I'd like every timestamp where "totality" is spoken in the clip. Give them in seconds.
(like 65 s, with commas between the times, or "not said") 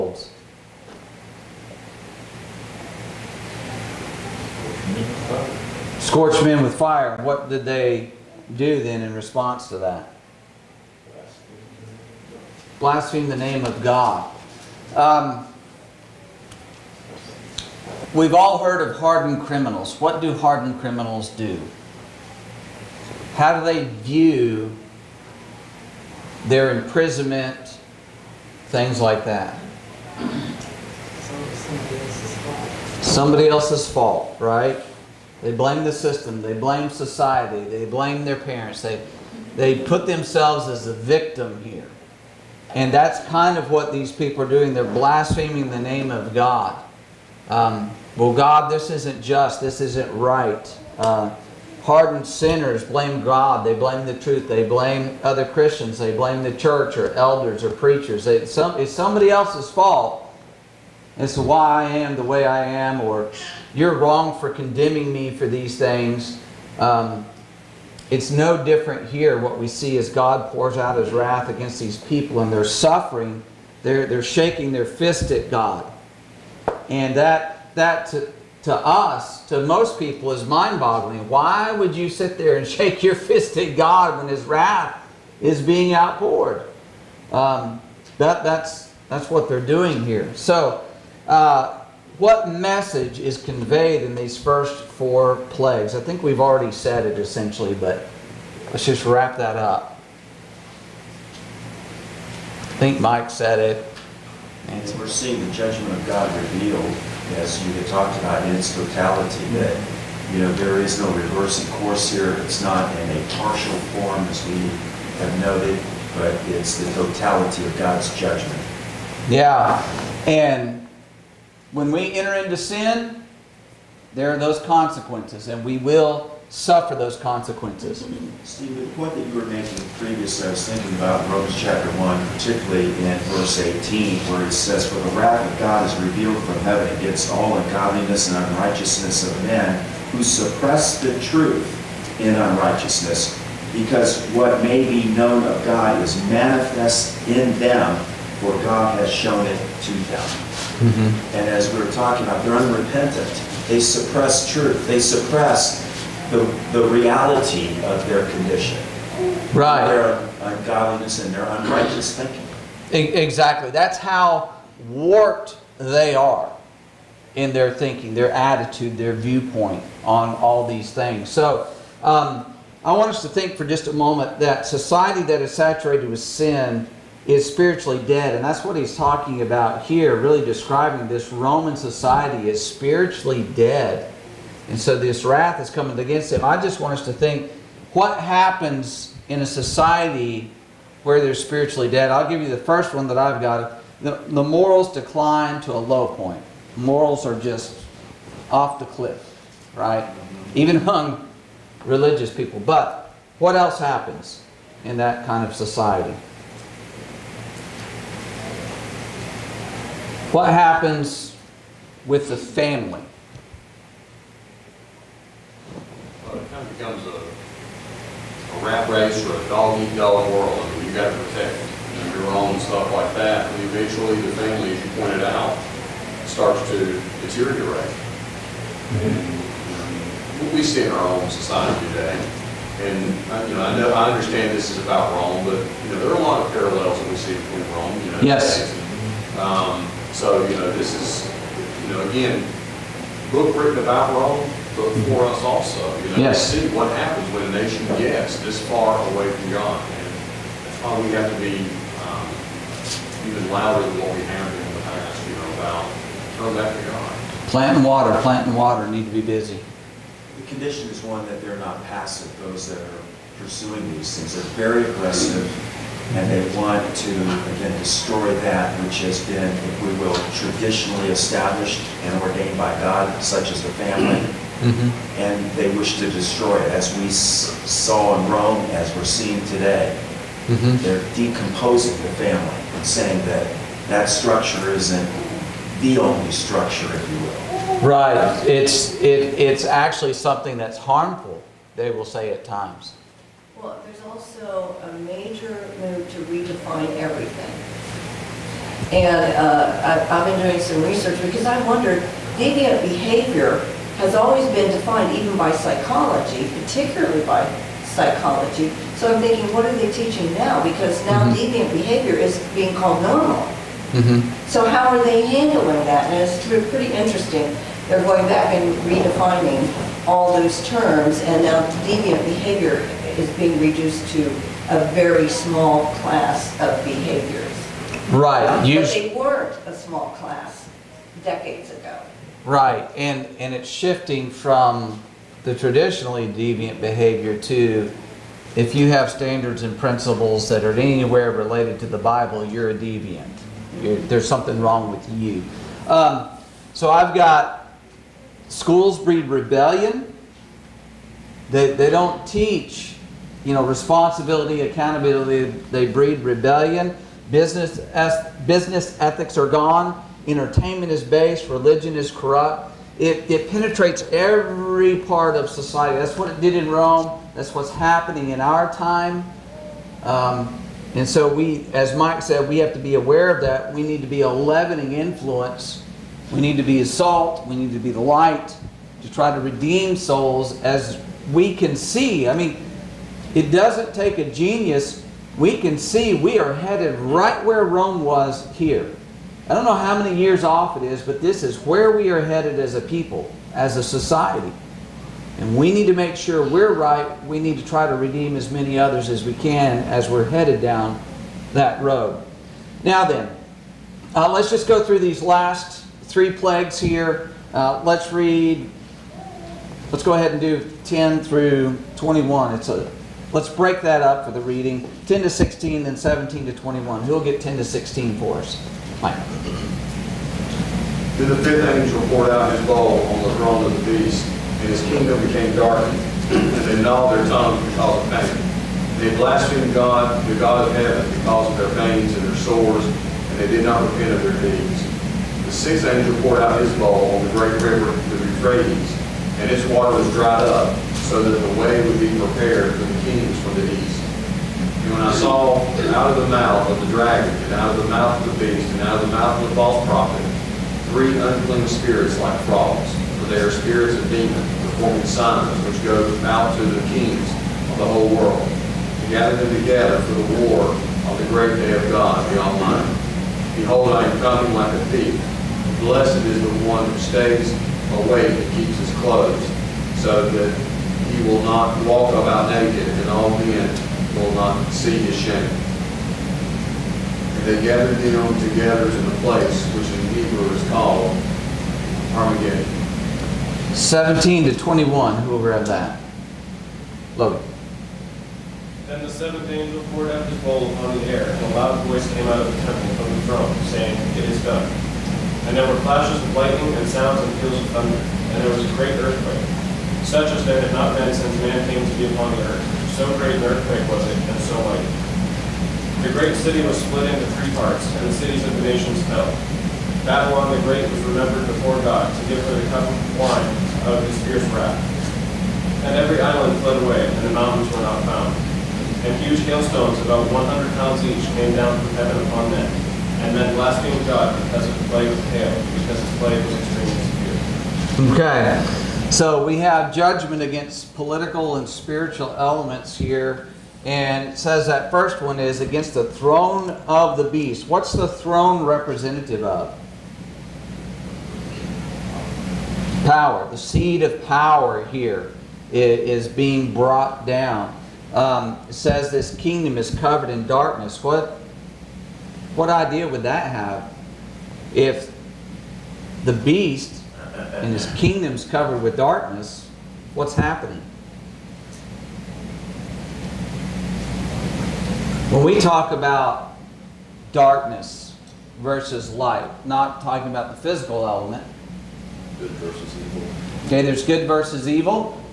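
108 s, 116 s.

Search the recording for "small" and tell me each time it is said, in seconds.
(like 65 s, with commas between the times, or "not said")
325 s, 329 s.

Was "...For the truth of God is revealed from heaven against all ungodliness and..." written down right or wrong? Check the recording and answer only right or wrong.
wrong.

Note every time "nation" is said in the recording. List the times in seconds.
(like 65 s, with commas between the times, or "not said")
247 s, 508 s.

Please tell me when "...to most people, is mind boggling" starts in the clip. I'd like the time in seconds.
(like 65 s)
79 s.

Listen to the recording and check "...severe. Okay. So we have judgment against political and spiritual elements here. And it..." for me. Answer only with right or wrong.
right.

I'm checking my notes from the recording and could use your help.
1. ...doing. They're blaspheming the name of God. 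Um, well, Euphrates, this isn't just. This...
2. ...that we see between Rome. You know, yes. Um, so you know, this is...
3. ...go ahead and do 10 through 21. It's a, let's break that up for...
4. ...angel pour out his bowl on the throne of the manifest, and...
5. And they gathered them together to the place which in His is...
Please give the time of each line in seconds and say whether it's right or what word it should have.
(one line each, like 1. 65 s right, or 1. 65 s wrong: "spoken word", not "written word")
1. 44 s wrong: "God", not "Euphrates"
2. 236 s right
3. 410 s right
4. 421 s wrong: "beast", not "manifest"
5. 477 s wrong: "Hebrew", not "His".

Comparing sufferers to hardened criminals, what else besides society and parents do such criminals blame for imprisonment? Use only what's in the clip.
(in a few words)
The system.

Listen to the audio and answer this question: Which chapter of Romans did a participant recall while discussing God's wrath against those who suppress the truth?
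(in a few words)
Chapter 1.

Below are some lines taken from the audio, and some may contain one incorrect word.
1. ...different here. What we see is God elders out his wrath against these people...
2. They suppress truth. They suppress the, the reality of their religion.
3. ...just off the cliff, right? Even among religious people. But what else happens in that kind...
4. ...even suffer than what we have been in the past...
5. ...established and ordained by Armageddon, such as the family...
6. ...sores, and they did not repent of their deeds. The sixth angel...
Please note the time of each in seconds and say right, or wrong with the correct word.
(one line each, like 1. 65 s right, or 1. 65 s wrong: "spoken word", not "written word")
1. 68 s wrong: "pours", not "elders"
2. 153 s wrong: "condition", not "religion"
3. 197 s right
4. 253 s wrong: "louder", not "suffer"
5. 271 s wrong: "God", not "Armageddon"
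6. 432 s right.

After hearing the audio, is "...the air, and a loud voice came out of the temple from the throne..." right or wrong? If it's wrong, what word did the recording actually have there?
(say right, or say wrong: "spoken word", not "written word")
right.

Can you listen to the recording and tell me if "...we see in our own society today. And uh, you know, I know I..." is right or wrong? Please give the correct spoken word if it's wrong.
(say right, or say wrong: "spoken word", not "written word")
right.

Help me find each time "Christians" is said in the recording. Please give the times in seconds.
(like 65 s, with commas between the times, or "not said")
55 s.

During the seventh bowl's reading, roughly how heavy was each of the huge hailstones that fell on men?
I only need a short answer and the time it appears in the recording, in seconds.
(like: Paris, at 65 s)
100 pounds, at 520 s.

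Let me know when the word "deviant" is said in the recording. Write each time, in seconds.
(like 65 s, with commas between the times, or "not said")
302 s, 311 s, 321 s, 336 s, 342 s.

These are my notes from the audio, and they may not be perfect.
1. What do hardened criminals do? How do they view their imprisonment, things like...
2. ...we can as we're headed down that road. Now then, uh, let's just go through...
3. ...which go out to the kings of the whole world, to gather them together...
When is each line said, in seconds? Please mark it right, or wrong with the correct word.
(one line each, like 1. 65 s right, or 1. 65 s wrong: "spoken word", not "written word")
1. 19 s right
2. 399 s right
3. 455 s right.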